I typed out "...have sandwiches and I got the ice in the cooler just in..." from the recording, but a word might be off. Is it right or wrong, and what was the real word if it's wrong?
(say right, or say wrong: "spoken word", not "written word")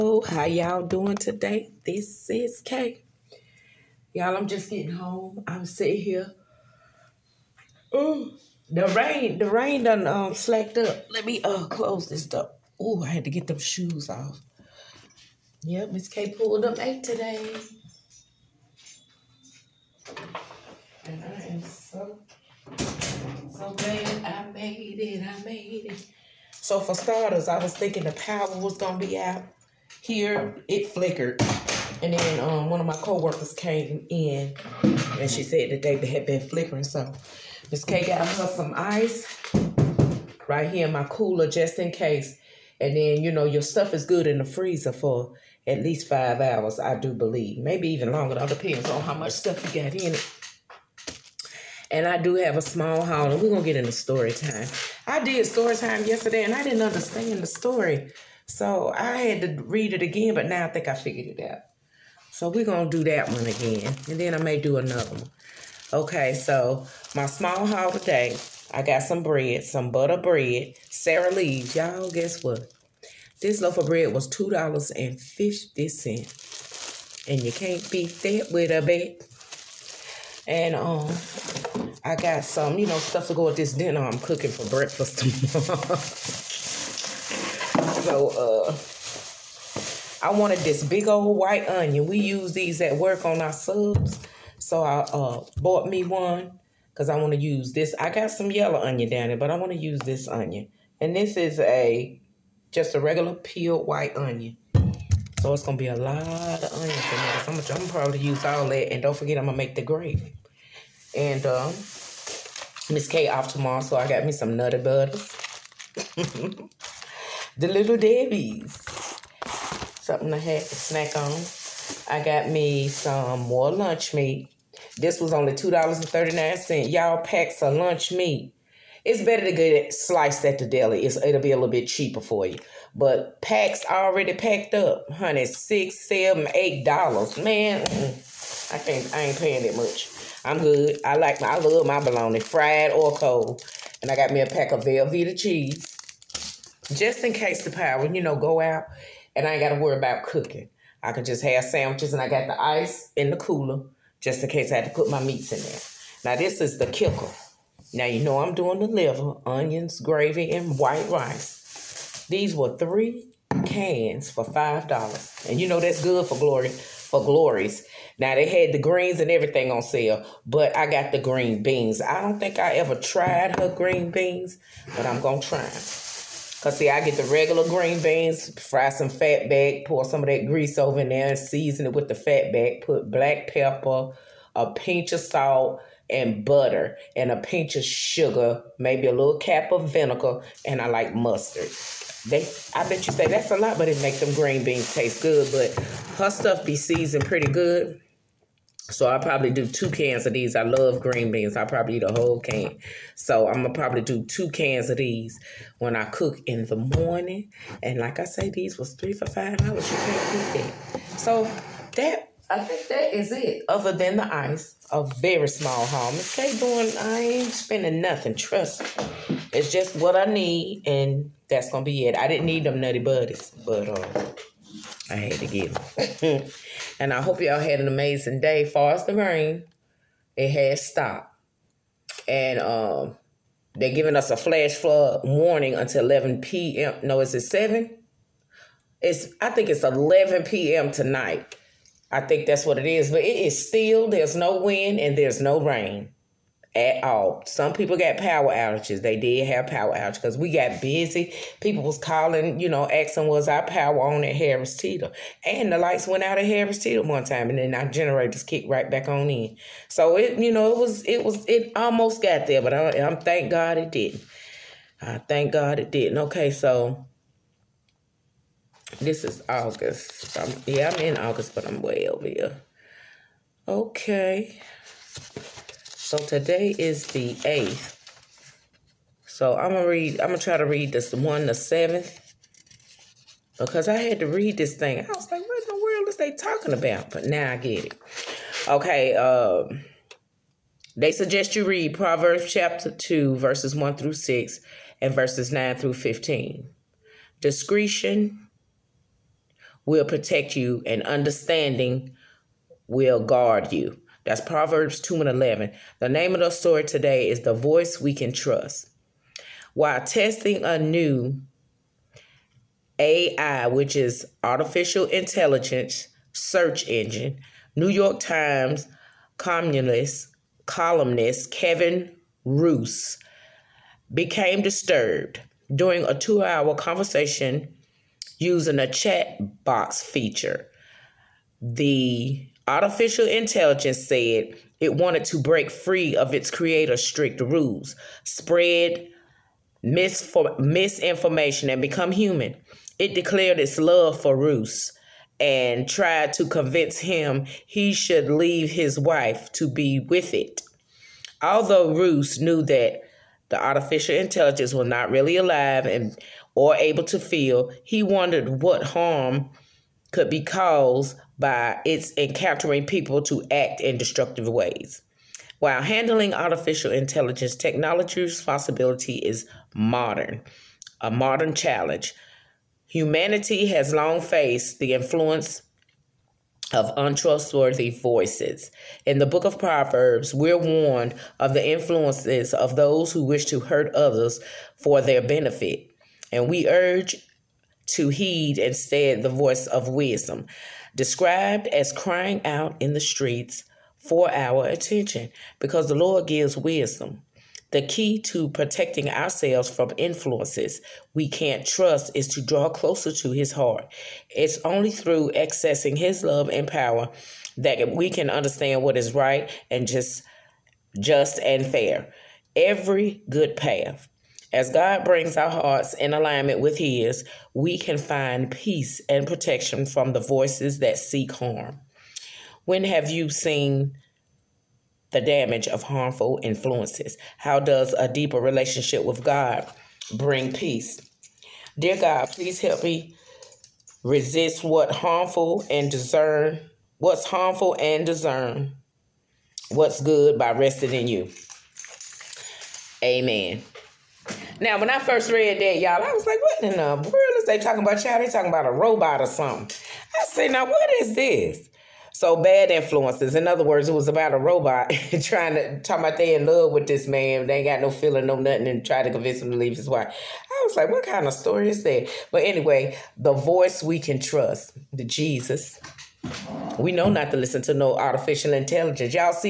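right.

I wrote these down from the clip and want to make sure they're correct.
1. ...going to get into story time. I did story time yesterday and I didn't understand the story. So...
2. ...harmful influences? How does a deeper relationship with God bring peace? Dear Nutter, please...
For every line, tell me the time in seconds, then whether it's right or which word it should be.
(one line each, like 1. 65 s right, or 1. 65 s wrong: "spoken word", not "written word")
1. 53 s right
2. 425 s wrong: "God", not "Nutter".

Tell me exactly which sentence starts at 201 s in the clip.
I probably eat a whole can.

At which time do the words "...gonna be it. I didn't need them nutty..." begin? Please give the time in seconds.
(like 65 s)
221 s.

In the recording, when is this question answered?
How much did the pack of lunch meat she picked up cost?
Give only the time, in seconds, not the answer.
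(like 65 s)
125 s.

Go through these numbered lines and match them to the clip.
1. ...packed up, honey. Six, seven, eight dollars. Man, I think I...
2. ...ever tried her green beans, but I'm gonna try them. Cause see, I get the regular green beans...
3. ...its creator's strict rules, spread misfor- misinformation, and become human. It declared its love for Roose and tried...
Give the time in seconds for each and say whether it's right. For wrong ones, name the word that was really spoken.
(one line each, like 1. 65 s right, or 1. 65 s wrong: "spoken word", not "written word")
1. 134 s right
2. 172 s right
3. 336 s right.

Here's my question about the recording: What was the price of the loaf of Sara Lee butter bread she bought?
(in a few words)
$2.50.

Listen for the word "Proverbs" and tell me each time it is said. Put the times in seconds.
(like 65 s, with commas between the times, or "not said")
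291 s, 304 s, 379 s.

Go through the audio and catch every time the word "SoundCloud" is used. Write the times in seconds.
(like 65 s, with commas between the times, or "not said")
not said.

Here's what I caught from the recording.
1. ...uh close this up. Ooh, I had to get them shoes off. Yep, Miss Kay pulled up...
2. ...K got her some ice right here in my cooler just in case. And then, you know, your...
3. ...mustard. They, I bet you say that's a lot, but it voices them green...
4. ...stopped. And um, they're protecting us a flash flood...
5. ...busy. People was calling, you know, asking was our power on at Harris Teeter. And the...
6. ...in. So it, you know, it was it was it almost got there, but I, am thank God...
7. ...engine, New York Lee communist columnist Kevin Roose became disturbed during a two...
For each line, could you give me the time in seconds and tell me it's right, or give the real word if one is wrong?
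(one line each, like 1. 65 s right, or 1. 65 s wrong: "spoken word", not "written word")
1. 11 s right
2. 37 s right
3. 191 s wrong: "makes", not "voices"
4. 230 s wrong: "giving", not "protecting"
5. 250 s right
6. 259 s right
7. 316 s wrong: "Times", not "Lee".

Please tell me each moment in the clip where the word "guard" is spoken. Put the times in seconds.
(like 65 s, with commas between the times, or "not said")
303 s.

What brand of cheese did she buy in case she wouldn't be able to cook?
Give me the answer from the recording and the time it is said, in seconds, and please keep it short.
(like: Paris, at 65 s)
Velveeta, at 144 s.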